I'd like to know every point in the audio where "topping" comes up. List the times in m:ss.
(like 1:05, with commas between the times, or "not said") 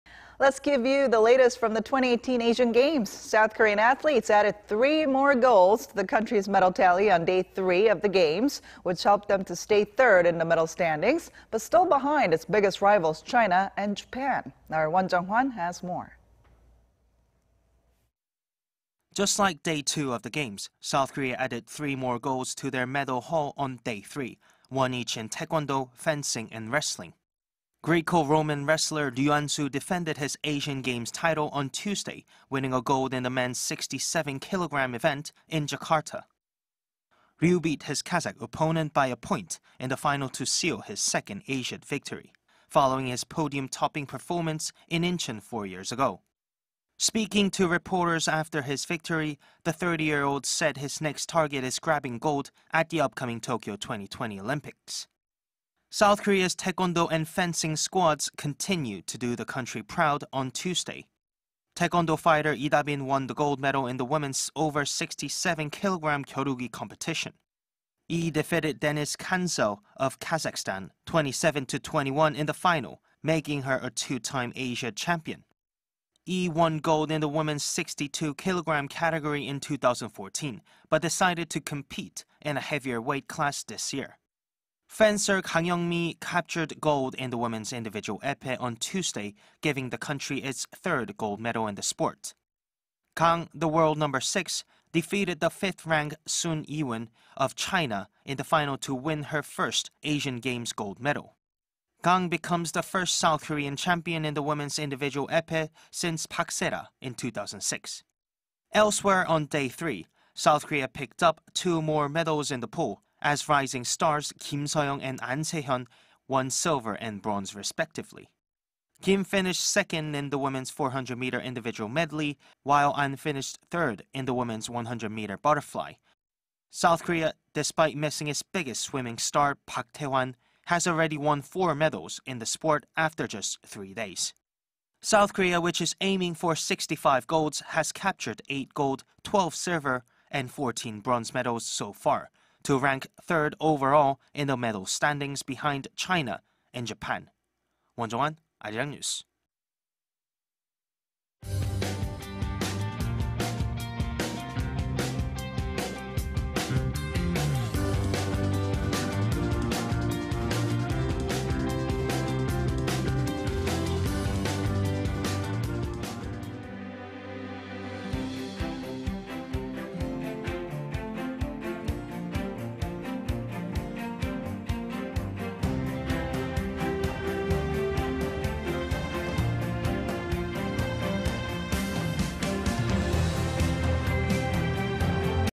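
0:43.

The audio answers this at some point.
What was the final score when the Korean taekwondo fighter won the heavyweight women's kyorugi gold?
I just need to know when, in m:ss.
1:11.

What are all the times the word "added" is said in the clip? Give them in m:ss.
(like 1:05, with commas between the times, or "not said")
0:04, 0:21.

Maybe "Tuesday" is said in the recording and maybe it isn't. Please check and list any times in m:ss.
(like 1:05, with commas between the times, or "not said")
0:31, 1:00, 1:28.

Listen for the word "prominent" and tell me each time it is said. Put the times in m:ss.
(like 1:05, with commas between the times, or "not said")
not said.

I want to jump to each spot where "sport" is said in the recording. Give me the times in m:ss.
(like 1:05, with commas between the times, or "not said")
1:31, 2:12.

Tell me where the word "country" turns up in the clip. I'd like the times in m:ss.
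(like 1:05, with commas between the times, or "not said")
0:06, 0:59, 1:29.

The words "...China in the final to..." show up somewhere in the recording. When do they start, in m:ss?
1:37.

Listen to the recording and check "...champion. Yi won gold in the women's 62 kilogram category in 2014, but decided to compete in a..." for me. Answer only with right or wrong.
right.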